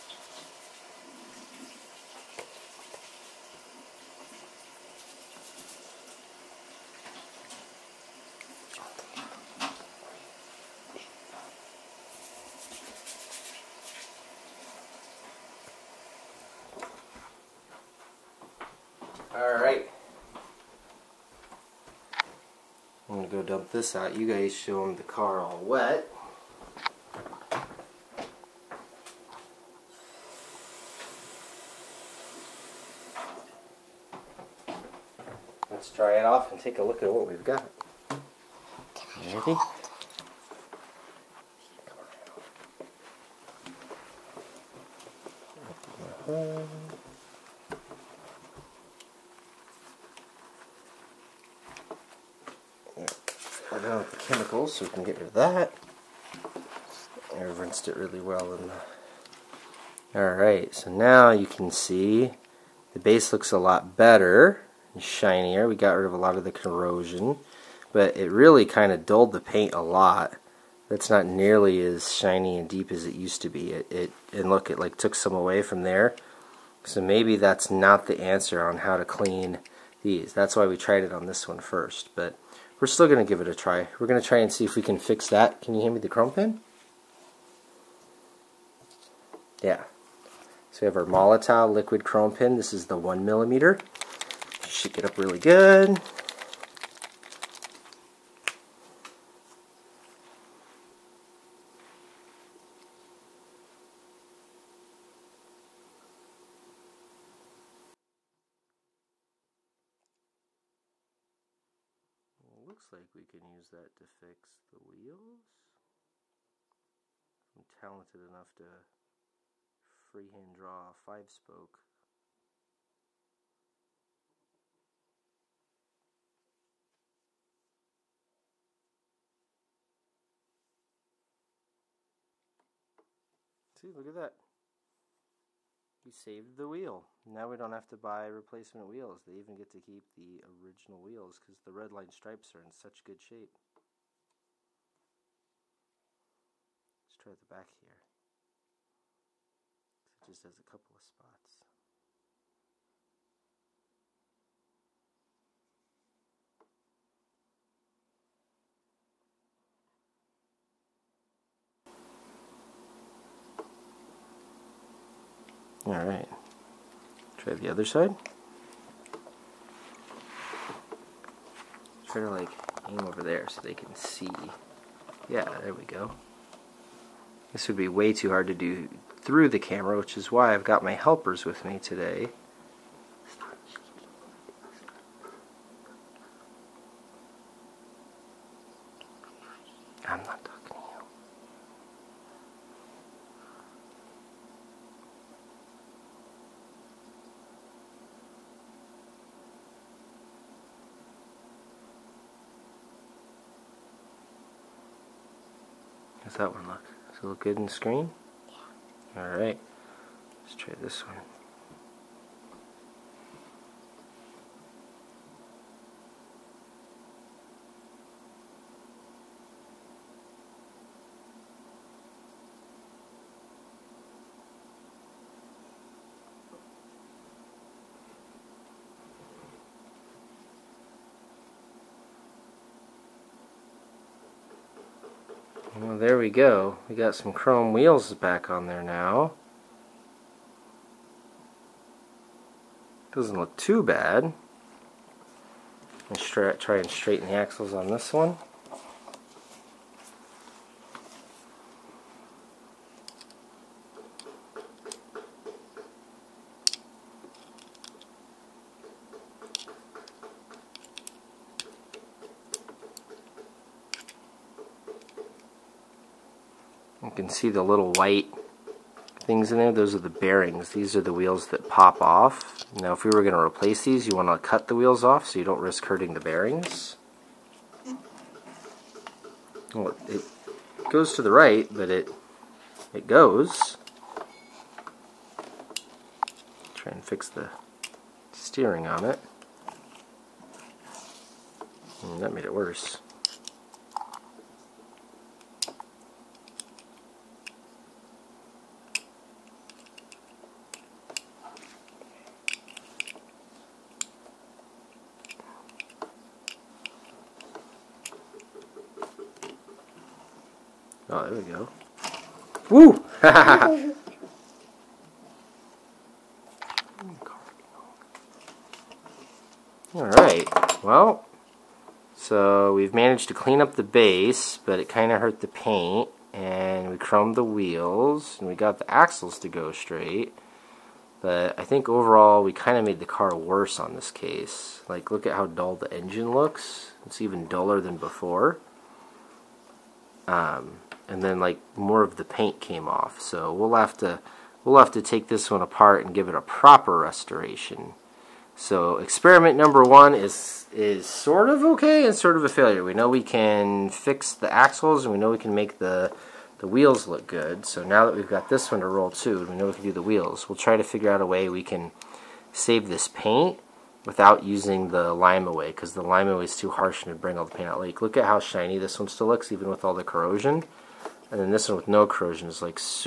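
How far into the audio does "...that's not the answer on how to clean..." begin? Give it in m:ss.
1:17.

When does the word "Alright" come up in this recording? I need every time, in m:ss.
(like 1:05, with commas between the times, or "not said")
1:00, 2:45, 3:29, 5:19.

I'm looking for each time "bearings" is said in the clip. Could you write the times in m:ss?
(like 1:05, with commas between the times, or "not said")
4:30, 4:36.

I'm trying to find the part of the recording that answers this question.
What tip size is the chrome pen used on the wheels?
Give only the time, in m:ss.
1:32.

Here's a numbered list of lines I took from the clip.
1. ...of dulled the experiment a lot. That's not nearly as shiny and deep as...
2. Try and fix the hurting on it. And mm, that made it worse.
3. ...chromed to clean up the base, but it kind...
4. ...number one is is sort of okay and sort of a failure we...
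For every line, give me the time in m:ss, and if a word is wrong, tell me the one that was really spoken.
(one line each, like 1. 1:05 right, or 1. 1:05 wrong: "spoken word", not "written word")
1. 1:08 wrong: "paint", not "experiment"
2. 4:46 wrong: "steering", not "hurting"
3. 5:22 wrong: "managed", not "chromed"
4. 5:49 right.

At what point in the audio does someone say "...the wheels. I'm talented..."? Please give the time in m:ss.
1:54.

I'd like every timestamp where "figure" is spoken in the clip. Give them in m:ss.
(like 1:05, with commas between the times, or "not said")
6:00.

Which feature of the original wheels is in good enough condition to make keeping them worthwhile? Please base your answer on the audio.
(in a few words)
red line stripes.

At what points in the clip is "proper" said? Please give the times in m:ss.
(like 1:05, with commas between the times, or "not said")
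5:46.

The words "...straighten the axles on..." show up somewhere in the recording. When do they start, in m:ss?
4:06.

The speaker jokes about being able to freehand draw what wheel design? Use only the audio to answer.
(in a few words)
five spoke.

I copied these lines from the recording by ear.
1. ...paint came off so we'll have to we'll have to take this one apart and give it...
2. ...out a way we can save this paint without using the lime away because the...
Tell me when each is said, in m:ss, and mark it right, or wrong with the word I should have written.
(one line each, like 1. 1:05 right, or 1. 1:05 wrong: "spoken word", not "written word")
1. 5:42 right
2. 6:01 right.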